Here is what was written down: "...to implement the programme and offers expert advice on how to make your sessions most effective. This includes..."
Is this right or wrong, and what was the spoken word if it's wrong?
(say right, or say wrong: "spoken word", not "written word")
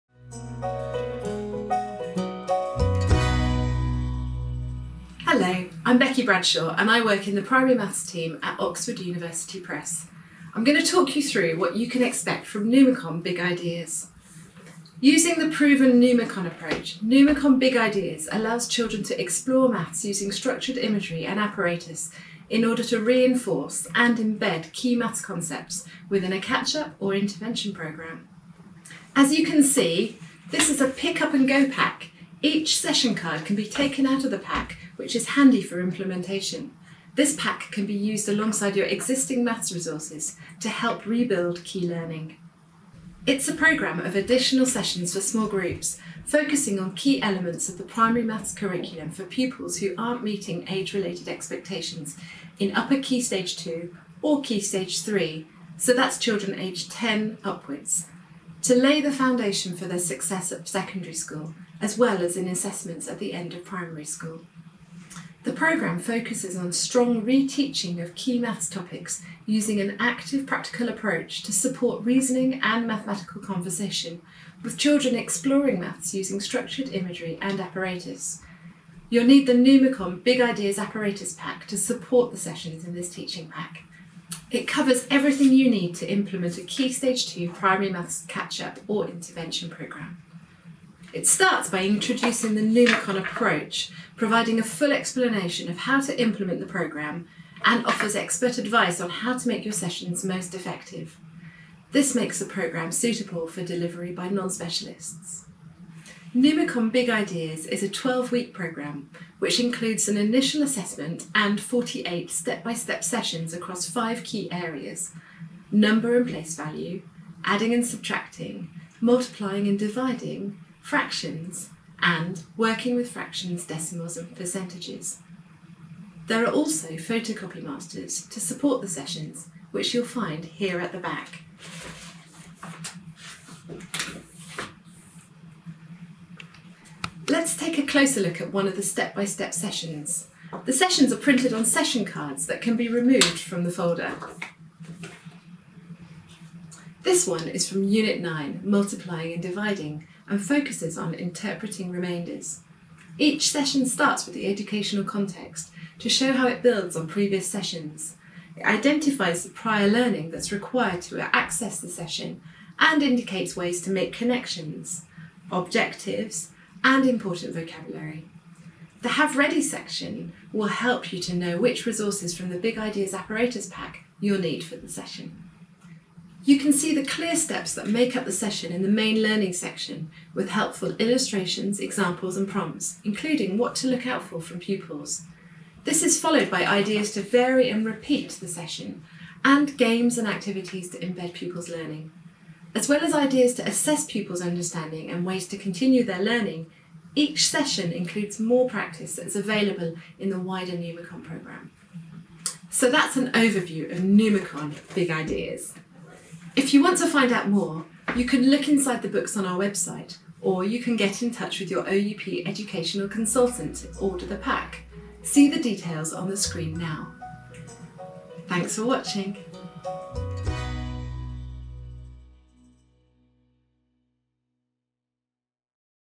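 wrong: "makes", not "includes".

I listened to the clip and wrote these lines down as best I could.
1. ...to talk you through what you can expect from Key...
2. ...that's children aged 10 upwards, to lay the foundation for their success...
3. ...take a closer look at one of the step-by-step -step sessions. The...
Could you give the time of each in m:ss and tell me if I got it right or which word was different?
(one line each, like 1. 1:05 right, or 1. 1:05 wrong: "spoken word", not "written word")
1. 0:10 wrong: "Numicon", not "Key"
2. 0:55 right
3. 2:17 right.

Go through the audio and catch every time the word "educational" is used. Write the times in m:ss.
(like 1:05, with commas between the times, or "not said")
2:34, 3:32.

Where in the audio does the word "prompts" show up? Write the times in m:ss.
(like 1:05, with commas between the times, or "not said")
3:02.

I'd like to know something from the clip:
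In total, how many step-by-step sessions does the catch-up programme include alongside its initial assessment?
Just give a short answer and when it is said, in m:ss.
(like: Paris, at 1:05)
48, at 1:51.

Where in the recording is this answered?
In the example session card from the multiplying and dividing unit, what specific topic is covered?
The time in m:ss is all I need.
2:31.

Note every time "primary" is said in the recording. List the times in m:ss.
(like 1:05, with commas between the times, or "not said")
0:07, 0:47, 1:03, 1:27.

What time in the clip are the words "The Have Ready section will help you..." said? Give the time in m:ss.
2:49.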